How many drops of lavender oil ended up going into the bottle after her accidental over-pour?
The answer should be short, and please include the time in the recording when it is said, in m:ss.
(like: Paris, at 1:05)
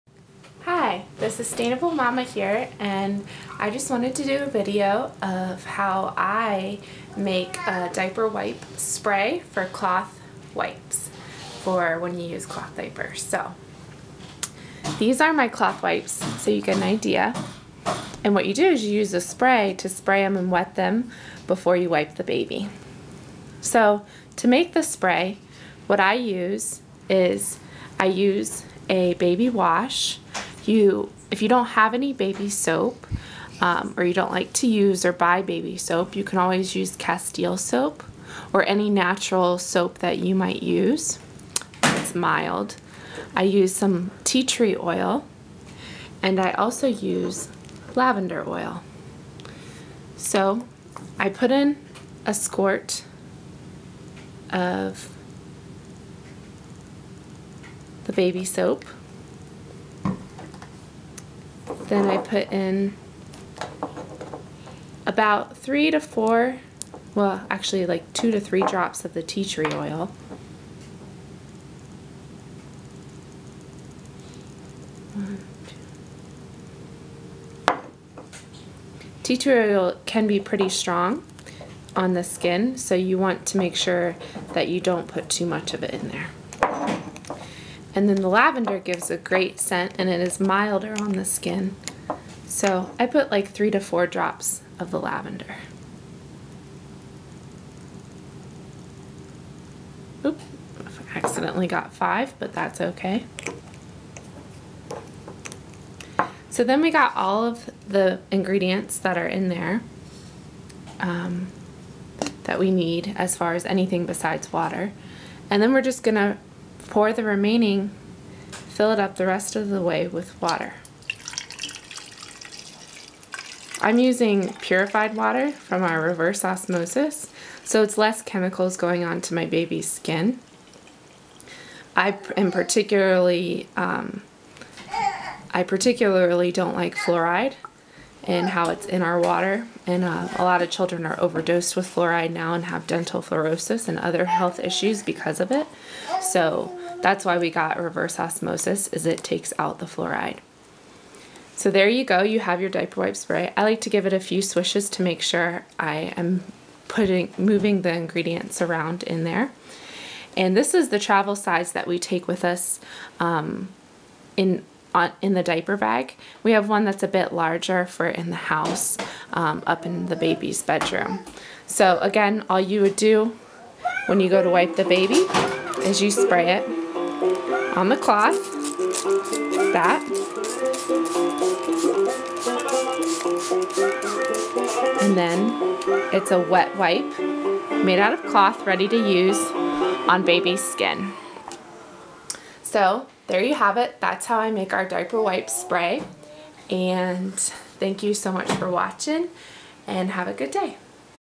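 5, at 1:41.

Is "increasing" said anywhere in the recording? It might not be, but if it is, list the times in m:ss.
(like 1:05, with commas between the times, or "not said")
not said.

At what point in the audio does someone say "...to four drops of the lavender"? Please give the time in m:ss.
1:33.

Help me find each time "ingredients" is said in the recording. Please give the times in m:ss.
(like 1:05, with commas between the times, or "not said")
1:48, 2:37.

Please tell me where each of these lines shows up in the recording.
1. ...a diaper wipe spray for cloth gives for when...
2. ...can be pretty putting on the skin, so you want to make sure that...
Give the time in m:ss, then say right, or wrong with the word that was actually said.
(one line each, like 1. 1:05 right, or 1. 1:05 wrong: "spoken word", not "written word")
1. 0:07 wrong: "wipes", not "gives"
2. 1:20 wrong: "strong", not "putting".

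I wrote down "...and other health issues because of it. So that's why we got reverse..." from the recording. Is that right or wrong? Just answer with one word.
right.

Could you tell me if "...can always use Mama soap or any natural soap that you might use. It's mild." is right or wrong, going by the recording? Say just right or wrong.
wrong.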